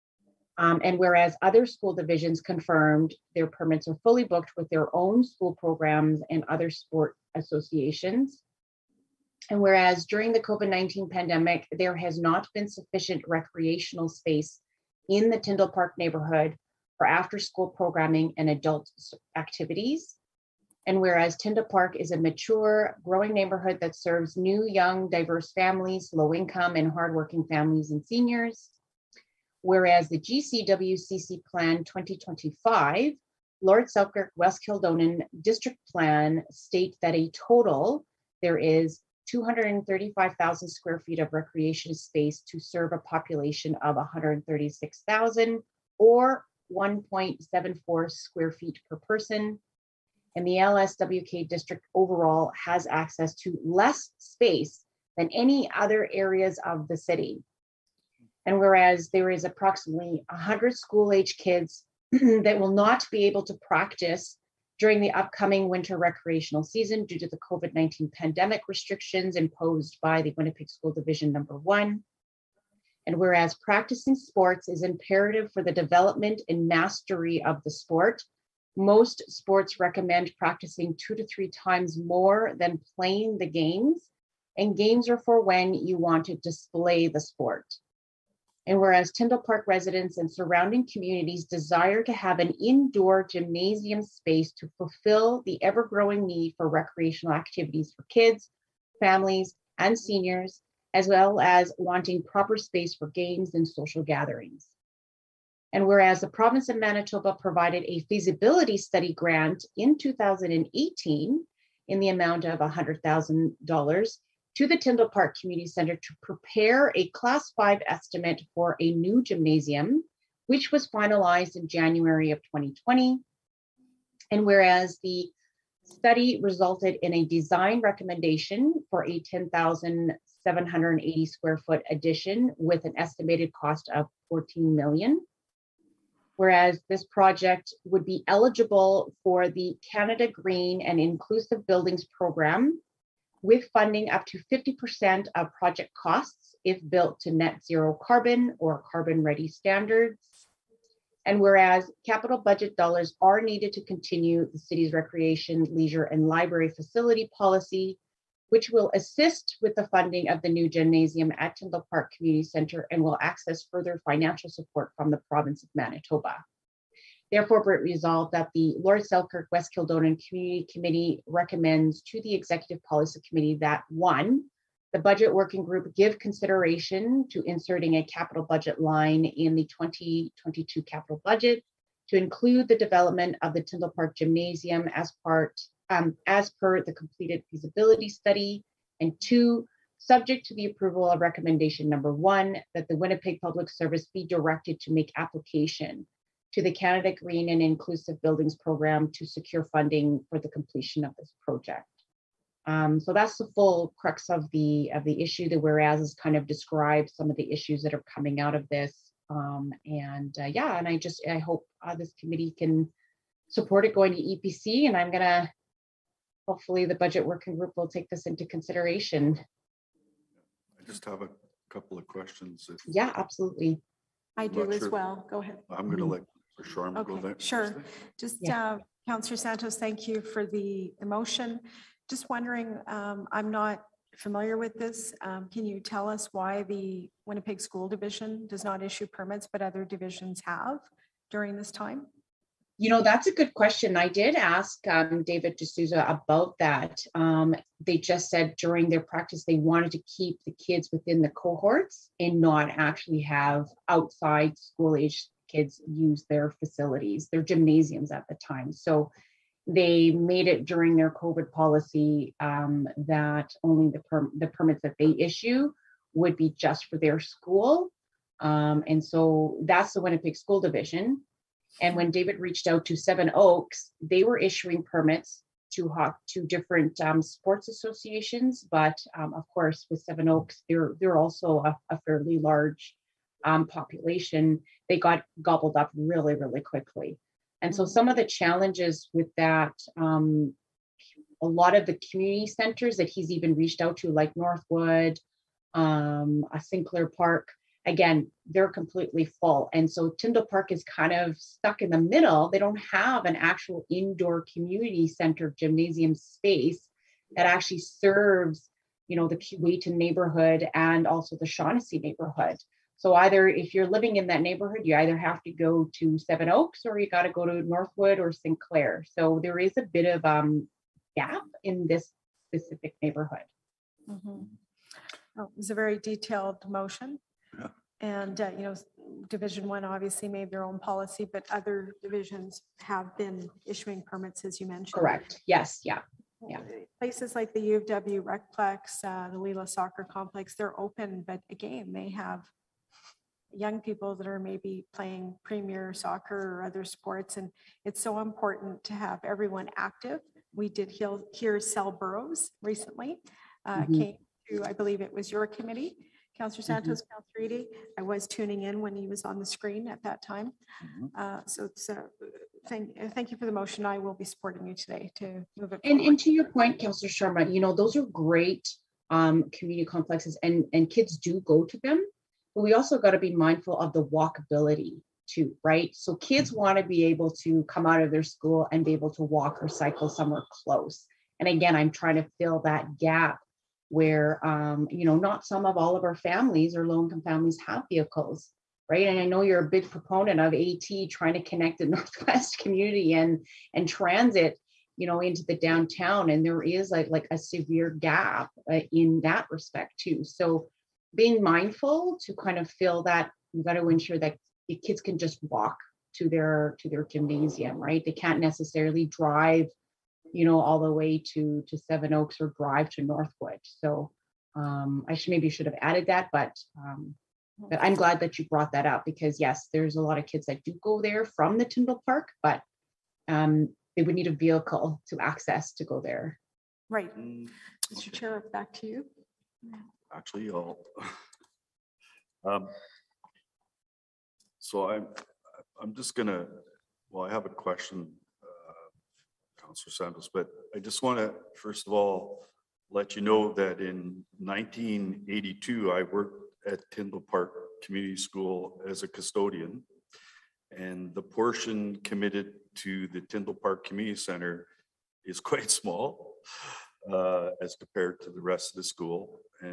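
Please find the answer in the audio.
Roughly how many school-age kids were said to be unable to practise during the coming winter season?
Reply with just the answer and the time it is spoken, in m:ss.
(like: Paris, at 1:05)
100, at 1:00.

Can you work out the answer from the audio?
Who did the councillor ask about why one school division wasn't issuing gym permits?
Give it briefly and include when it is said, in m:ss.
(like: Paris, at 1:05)
David D'Souza, at 4:05.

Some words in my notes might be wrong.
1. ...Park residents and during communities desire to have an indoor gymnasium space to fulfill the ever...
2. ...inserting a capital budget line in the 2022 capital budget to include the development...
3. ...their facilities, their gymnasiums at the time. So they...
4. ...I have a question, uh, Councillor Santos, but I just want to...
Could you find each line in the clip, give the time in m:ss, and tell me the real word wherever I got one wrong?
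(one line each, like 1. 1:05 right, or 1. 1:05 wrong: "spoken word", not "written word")
1. 1:29 wrong: "surrounding", not "during"
2. 2:57 right
3. 4:16 right
4. 7:17 right.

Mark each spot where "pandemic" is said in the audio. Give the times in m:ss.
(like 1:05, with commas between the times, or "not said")
0:11, 1:08.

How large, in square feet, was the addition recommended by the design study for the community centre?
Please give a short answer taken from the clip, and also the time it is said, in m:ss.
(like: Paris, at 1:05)
10,780 square feet, at 2:09.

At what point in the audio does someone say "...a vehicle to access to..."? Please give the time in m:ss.
7:04.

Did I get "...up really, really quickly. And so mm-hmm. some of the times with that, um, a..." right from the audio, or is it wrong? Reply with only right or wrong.
wrong.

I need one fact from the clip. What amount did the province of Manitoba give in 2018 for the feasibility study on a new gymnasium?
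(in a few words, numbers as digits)
$100,000.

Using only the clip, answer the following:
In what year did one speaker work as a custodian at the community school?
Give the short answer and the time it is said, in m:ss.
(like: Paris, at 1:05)
1982, at 7:24.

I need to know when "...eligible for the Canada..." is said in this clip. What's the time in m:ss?
2:18.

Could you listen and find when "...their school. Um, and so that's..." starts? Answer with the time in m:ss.
4:26.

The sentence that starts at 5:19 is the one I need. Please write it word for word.
So there is a bit of um, gap in this specific neighborhood.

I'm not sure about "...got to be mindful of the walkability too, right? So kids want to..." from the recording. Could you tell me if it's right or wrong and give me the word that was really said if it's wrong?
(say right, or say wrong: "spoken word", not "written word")
right.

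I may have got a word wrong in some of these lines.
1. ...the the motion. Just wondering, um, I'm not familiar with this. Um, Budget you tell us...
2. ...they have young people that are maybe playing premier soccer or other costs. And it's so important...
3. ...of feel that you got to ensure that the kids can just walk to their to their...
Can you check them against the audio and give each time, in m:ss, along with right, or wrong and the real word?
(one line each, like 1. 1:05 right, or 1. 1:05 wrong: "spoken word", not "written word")
1. 3:50 wrong: "Can", not "Budget"
2. 5:41 wrong: "sports", not "costs"
3. 6:42 right.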